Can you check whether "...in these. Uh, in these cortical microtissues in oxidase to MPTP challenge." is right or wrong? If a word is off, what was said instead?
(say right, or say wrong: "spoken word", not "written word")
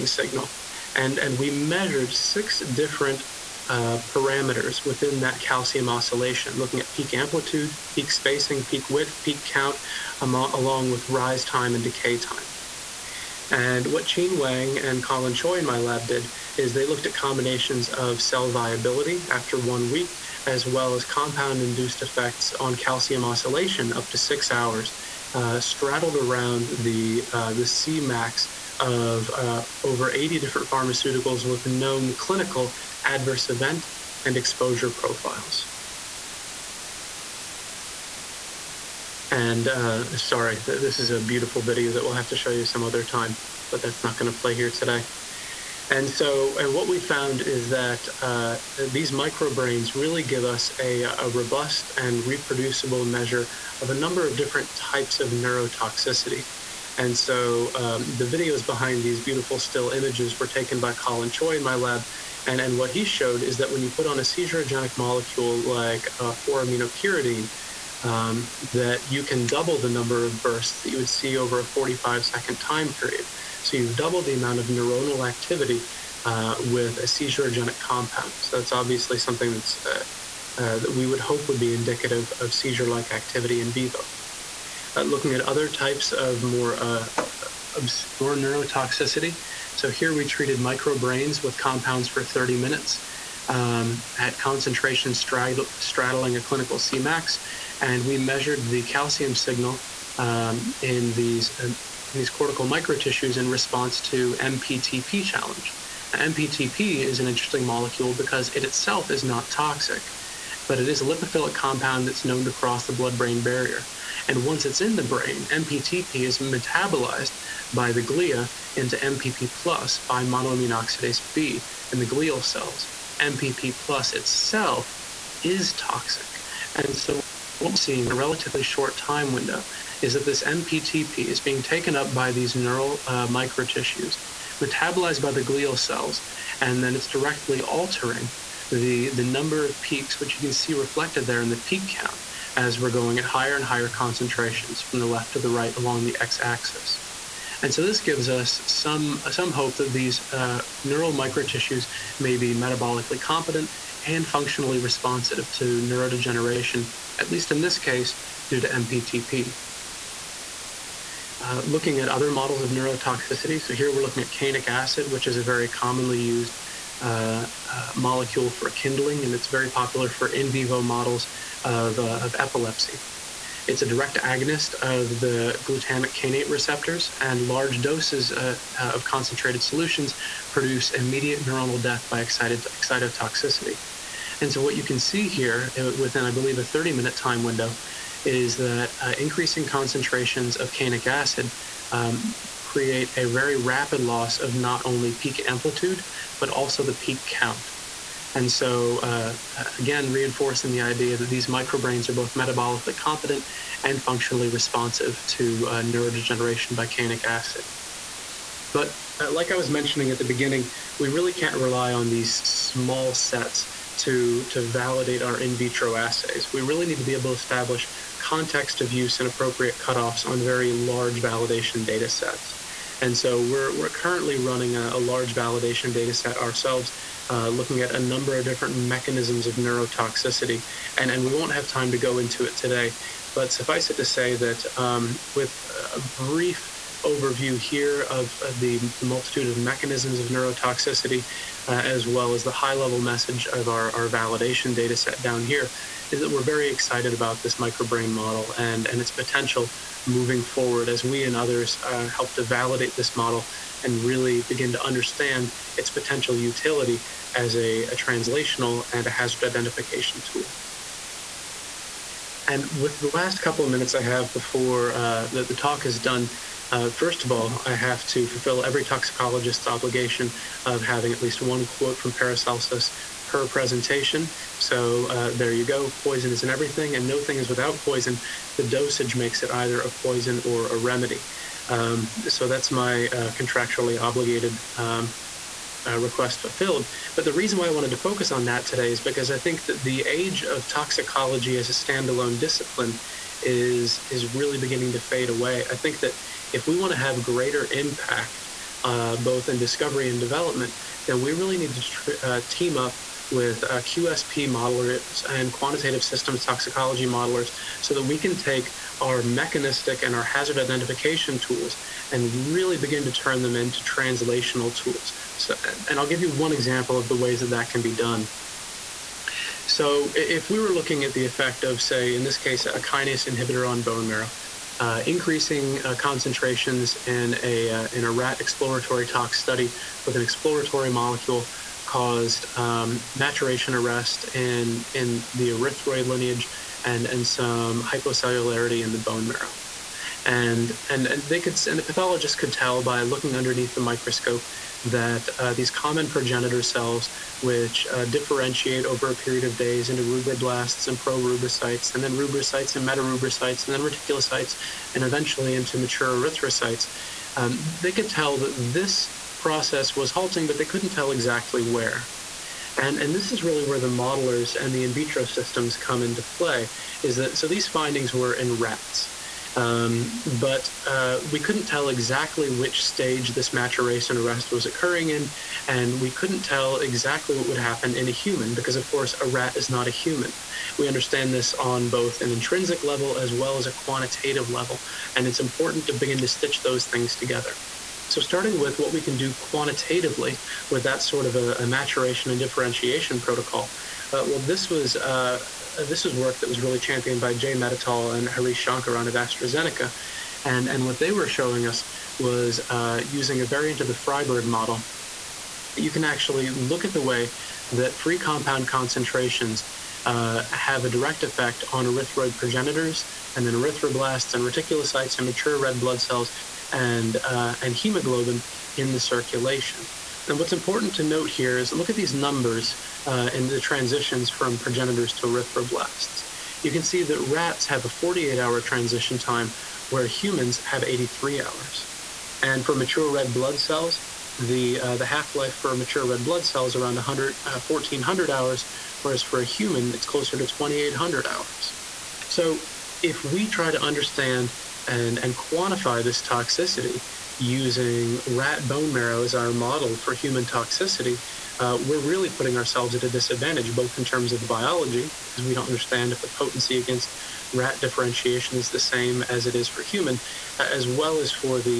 wrong: "response", not "oxidase".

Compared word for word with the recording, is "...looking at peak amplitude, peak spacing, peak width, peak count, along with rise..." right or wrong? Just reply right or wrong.
right.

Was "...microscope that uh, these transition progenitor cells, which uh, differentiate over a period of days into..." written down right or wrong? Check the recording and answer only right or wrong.
wrong.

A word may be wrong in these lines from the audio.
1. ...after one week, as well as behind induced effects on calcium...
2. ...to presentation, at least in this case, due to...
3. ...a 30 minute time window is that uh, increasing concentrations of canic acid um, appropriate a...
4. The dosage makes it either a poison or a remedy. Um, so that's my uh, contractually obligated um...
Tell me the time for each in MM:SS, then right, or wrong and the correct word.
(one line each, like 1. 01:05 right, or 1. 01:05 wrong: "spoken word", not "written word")
1. 00:19 wrong: "compound", not "behind"
2. 02:35 wrong: "neurodegeneration", not "presentation"
3. 03:06 wrong: "create", not "appropriate"
4. 04:38 right.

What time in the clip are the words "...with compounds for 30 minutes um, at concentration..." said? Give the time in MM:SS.
01:31.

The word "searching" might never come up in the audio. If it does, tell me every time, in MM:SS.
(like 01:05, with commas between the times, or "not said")
not said.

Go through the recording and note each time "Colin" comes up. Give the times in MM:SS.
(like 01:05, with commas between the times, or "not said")
00:15, 01:00.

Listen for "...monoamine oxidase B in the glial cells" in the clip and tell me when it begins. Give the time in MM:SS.
02:00.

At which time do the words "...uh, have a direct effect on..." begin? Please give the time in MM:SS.
06:50.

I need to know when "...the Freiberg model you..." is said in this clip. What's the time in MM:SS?
06:43.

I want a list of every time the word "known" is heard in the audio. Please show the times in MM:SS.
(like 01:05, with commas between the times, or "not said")
00:31, 01:52.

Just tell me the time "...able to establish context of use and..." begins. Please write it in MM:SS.
03:37.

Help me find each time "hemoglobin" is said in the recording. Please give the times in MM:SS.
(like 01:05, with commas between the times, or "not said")
06:57.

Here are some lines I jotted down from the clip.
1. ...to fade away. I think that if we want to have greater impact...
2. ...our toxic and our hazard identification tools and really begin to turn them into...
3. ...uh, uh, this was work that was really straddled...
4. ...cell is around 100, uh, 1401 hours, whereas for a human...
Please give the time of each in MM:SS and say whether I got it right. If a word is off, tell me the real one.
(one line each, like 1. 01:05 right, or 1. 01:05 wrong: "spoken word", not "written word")
1. 04:54 right
2. 05:08 wrong: "mechanistic", not "toxic"
3. 06:34 wrong: "championed", not "straddled"
4. 07:16 wrong: "1400", not "1401".